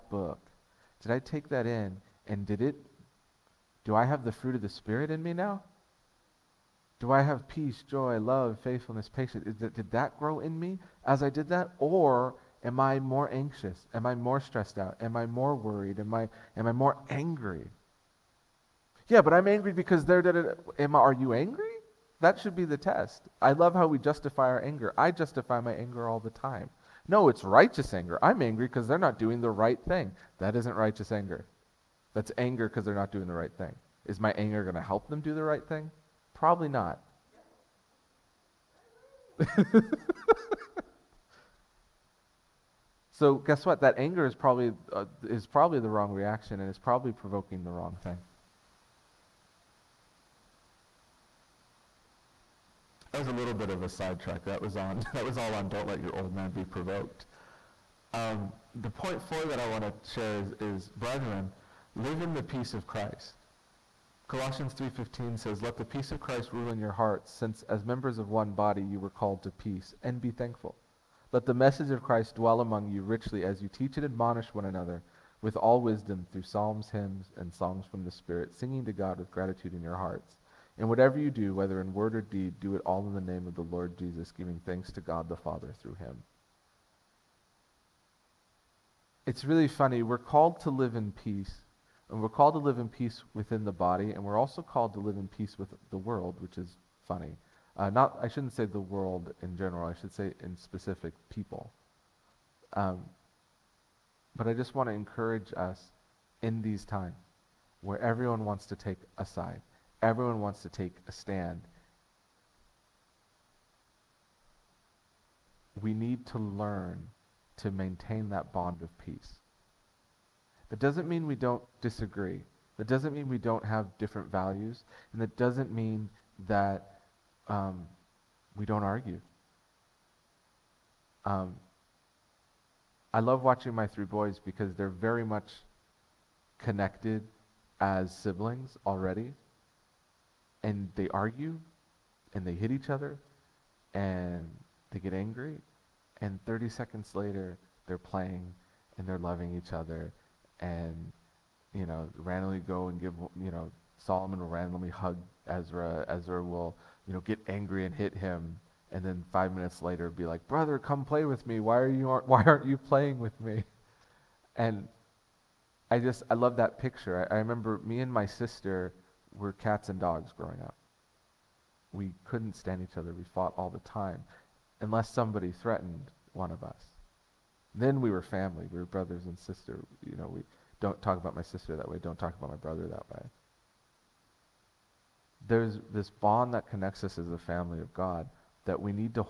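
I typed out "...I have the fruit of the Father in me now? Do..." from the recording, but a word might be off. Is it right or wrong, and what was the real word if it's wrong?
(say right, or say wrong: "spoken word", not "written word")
wrong: "Spirit", not "Father".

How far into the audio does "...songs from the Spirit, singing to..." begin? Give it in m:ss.
1:17.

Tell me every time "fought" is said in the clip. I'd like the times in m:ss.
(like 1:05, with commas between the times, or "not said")
2:53.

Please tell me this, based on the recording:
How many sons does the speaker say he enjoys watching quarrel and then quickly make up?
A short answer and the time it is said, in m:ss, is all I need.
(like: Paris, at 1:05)
3, at 2:13.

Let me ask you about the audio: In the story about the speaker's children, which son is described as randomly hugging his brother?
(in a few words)
Solomon.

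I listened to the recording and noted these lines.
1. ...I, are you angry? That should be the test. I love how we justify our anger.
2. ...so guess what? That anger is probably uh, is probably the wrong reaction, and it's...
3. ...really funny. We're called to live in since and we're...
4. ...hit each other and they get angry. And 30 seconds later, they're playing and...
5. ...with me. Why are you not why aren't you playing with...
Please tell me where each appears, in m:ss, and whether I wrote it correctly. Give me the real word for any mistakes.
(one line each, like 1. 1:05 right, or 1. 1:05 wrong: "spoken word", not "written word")
1. 0:20 right
2. 0:43 right
3. 1:29 wrong: "peace", not "since"
4. 2:22 right
5. 2:41 right.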